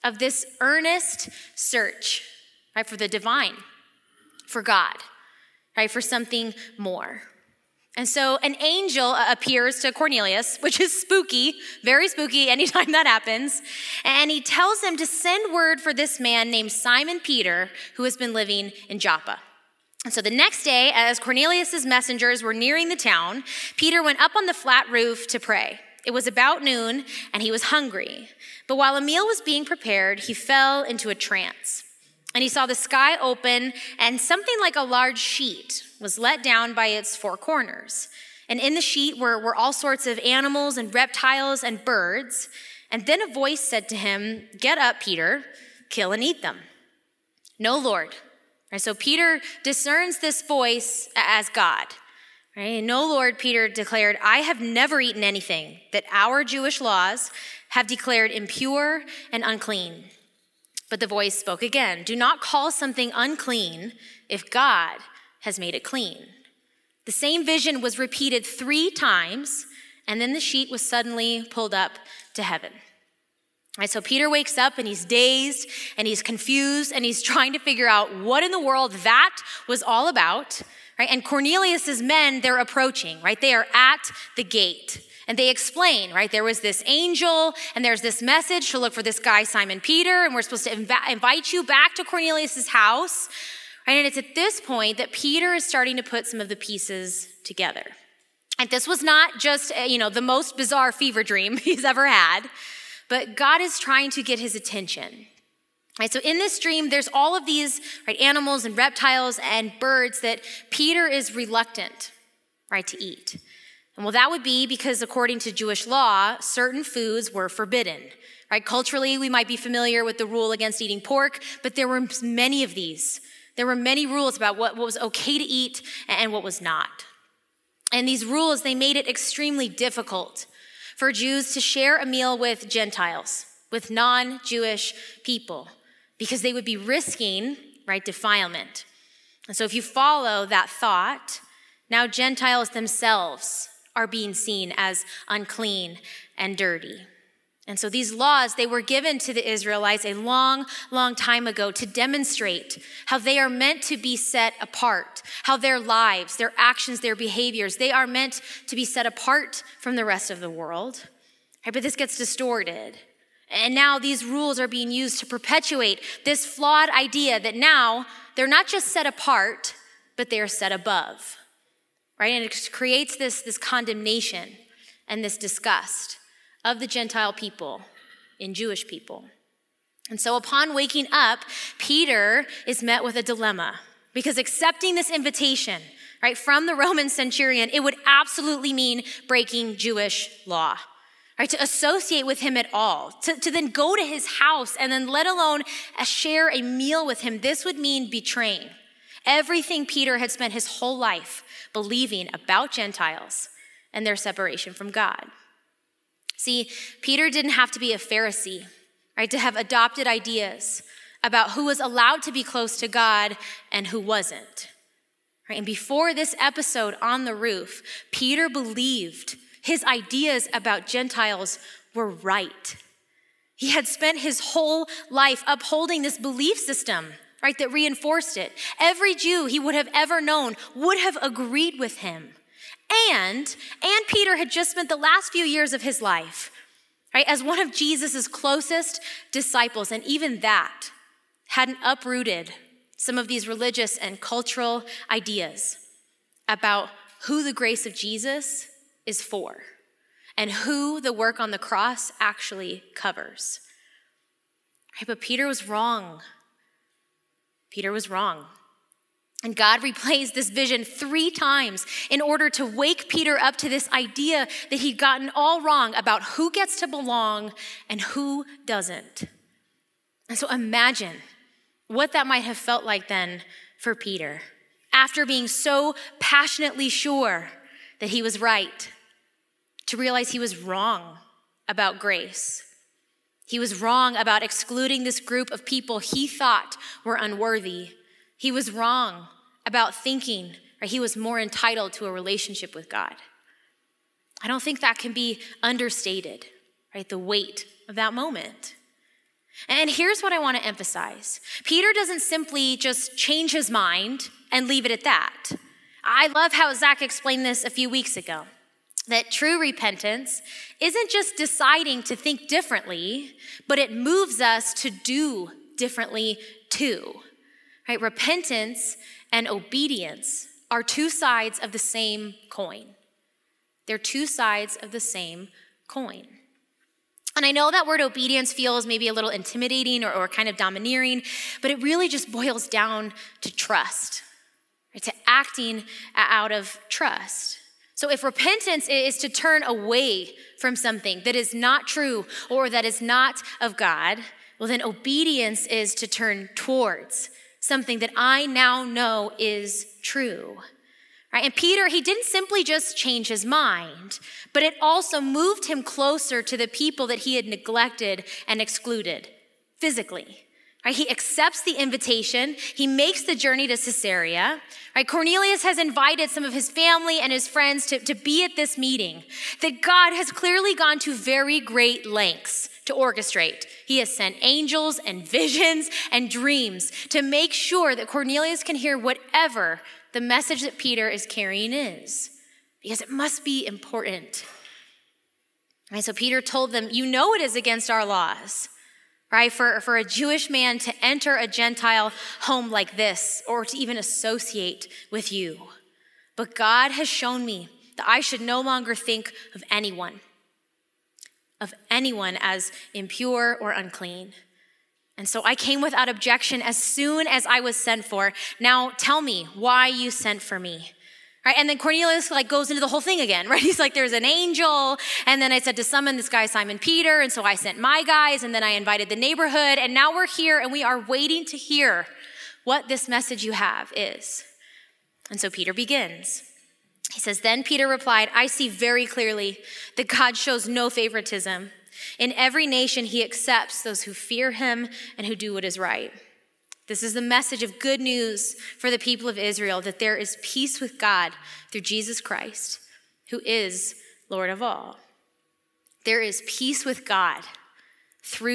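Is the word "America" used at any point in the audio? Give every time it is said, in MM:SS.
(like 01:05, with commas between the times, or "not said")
not said.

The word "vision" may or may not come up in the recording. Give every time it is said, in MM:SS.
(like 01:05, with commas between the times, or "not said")
01:07, 04:20, 06:15.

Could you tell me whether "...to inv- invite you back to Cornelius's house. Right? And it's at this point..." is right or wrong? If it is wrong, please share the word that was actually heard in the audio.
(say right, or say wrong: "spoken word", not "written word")
right.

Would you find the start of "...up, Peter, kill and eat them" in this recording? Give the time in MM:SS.
00:44.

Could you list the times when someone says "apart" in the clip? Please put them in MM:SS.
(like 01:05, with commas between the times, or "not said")
02:34, 02:39, 02:49.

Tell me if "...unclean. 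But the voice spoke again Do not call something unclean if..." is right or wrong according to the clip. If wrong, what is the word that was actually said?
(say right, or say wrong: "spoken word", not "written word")
right.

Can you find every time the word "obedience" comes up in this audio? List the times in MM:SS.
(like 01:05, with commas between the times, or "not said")
05:19, 05:27, 05:44.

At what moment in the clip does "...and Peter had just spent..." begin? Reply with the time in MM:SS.
03:53.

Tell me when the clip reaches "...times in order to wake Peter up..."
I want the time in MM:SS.
04:21.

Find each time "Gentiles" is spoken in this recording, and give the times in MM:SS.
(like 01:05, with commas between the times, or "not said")
02:12, 02:22, 02:56, 03:22, 03:40, 06:31.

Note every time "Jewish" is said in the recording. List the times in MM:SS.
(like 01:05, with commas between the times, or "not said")
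00:56, 01:55, 02:14, 02:58, 03:09, 06:30.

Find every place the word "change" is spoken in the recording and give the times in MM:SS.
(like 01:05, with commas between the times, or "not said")
05:03, 05:52.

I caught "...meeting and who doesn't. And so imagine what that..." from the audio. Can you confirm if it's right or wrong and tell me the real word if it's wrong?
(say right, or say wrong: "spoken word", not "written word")
wrong: "belong", not "meeting".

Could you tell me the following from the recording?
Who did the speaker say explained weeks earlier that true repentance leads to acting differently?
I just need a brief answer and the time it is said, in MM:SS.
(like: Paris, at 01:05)
Zach, at 05:06.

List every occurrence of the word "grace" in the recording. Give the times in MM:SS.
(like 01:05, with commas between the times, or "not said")
04:07, 04:41.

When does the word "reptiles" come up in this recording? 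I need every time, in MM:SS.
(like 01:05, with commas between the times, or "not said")
00:40, 01:48.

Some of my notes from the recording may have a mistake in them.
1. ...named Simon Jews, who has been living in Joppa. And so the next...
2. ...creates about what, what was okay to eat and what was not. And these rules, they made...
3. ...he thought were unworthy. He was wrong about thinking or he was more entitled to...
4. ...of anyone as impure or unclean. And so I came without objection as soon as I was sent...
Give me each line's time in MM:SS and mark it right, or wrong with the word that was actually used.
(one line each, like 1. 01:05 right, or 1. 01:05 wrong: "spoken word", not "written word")
1. 00:16 wrong: "Peter", not "Jews"
2. 02:04 wrong: "rules", not "creates"
3. 04:45 right
4. 06:41 right.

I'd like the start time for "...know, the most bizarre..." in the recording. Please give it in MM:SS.
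01:39.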